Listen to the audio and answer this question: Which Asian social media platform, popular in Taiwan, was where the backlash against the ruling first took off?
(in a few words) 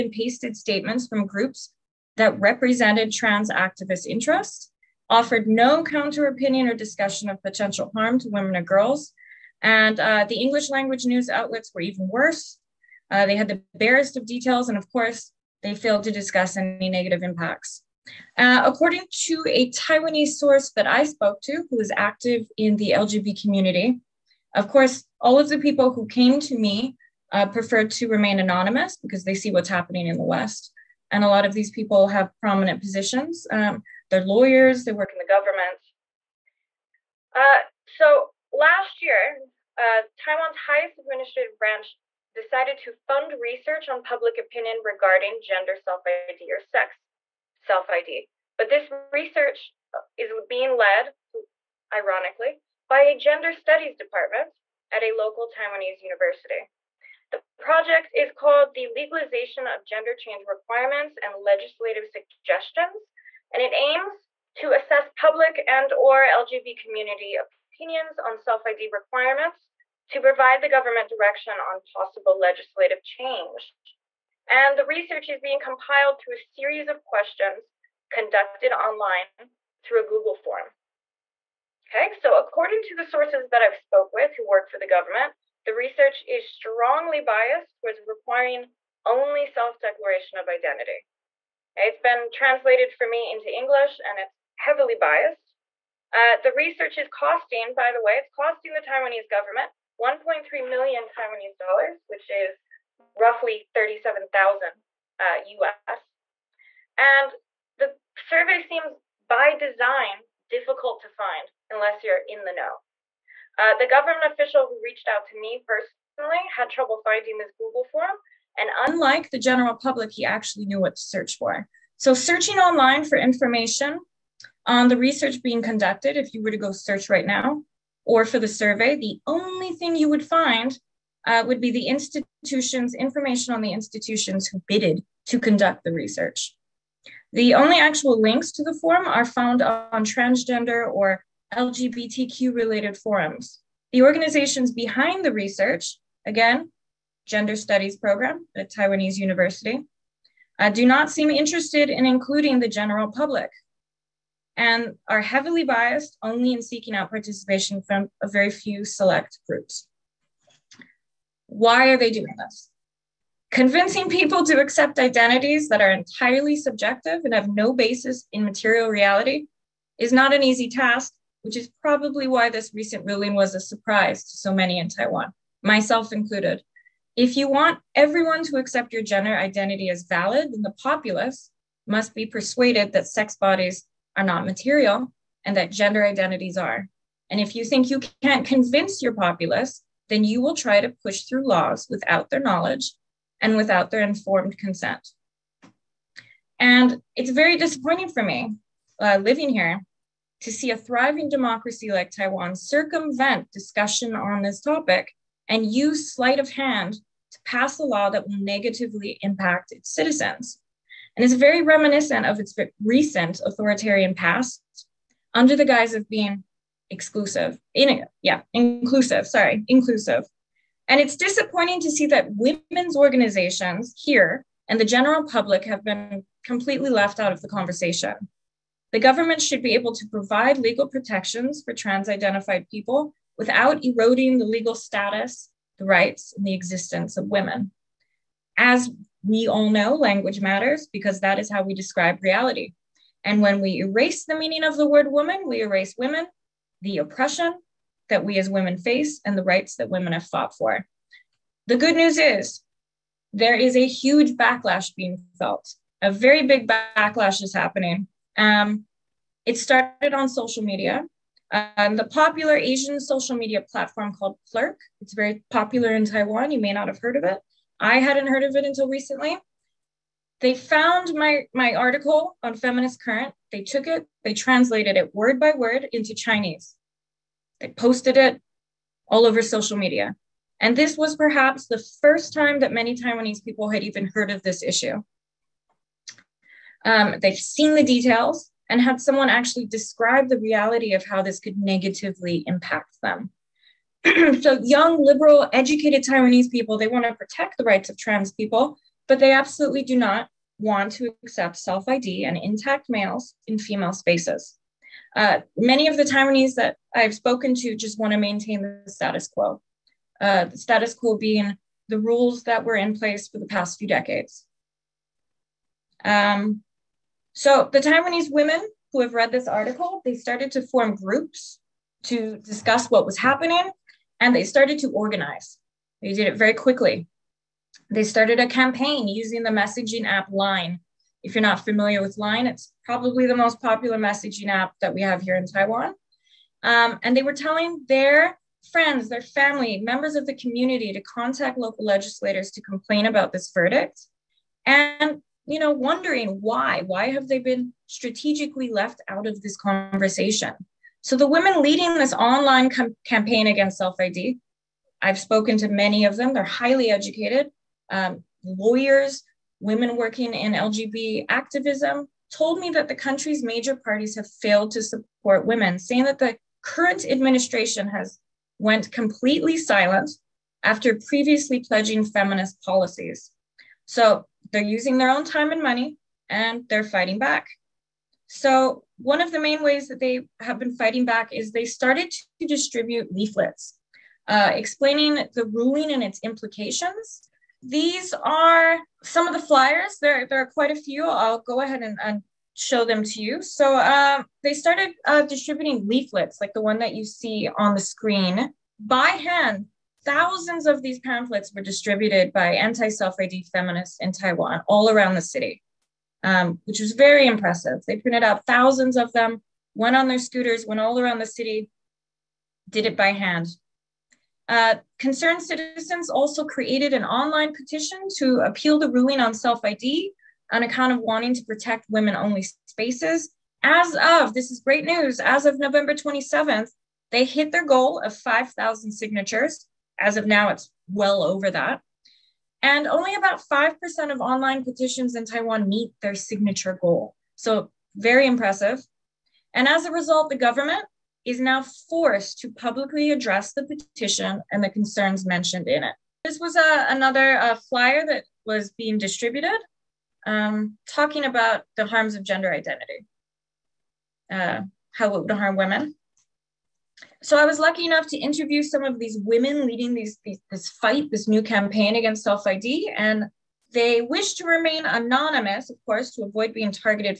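Plurk.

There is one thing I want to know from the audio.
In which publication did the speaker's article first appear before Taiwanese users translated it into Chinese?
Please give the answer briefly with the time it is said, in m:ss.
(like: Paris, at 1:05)
Feminist Current, at 4:32.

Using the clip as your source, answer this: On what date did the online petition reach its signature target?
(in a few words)
November 27th.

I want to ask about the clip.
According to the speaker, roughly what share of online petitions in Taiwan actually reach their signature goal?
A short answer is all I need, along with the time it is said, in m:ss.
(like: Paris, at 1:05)
5%, at 7:13.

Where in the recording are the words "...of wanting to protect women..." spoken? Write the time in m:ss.
7:00.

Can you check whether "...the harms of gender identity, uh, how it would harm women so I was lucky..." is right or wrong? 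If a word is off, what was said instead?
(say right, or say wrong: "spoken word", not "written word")
right.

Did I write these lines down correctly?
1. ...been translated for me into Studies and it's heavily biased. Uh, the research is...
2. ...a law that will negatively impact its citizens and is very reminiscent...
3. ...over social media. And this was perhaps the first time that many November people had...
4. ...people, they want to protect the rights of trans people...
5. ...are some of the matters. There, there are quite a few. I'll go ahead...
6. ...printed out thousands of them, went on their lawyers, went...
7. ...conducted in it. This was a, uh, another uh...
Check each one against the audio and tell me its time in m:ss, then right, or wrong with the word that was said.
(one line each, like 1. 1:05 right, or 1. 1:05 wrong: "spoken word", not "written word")
1. 1:31 wrong: "English", not "Studies"
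2. 3:27 right
3. 4:39 wrong: "Taiwanese", not "November"
4. 4:56 right
5. 6:28 wrong: "flyers", not "matters"
6. 6:47 wrong: "scooters", not "lawyers"
7. 7:25 wrong: "mentioned", not "conducted".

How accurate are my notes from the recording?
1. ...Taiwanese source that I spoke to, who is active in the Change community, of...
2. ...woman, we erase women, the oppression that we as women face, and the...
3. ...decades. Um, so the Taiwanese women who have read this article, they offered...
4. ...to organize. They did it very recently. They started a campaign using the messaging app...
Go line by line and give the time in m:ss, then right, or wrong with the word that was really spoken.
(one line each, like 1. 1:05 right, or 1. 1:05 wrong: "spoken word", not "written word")
1. 0:19 wrong: "LGBT", not "Change"
2. 4:05 right
3. 5:13 wrong: "started", not "offered"
4. 5:24 wrong: "quickly", not "recently".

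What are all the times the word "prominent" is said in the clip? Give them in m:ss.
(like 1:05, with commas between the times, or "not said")
0:32.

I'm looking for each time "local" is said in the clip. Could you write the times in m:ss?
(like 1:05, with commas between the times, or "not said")
0:55, 5:41.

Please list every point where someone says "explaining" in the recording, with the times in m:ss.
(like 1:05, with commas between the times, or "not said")
6:24.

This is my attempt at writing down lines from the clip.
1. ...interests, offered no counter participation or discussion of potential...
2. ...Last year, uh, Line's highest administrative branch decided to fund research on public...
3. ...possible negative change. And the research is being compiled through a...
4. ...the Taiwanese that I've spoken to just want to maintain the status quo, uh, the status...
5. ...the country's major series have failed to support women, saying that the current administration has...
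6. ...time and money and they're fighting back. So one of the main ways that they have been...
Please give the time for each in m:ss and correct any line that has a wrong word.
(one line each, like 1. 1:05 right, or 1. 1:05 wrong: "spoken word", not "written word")
1. 0:04 wrong: "opinion", not "participation"
2. 0:38 wrong: "Taiwan", not "Line"
3. 1:11 wrong: "legislative", not "negative"
4. 5:05 right
5. 6:02 wrong: "parties", not "series"
6. 6:15 right.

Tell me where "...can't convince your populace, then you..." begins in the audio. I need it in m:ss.
3:08.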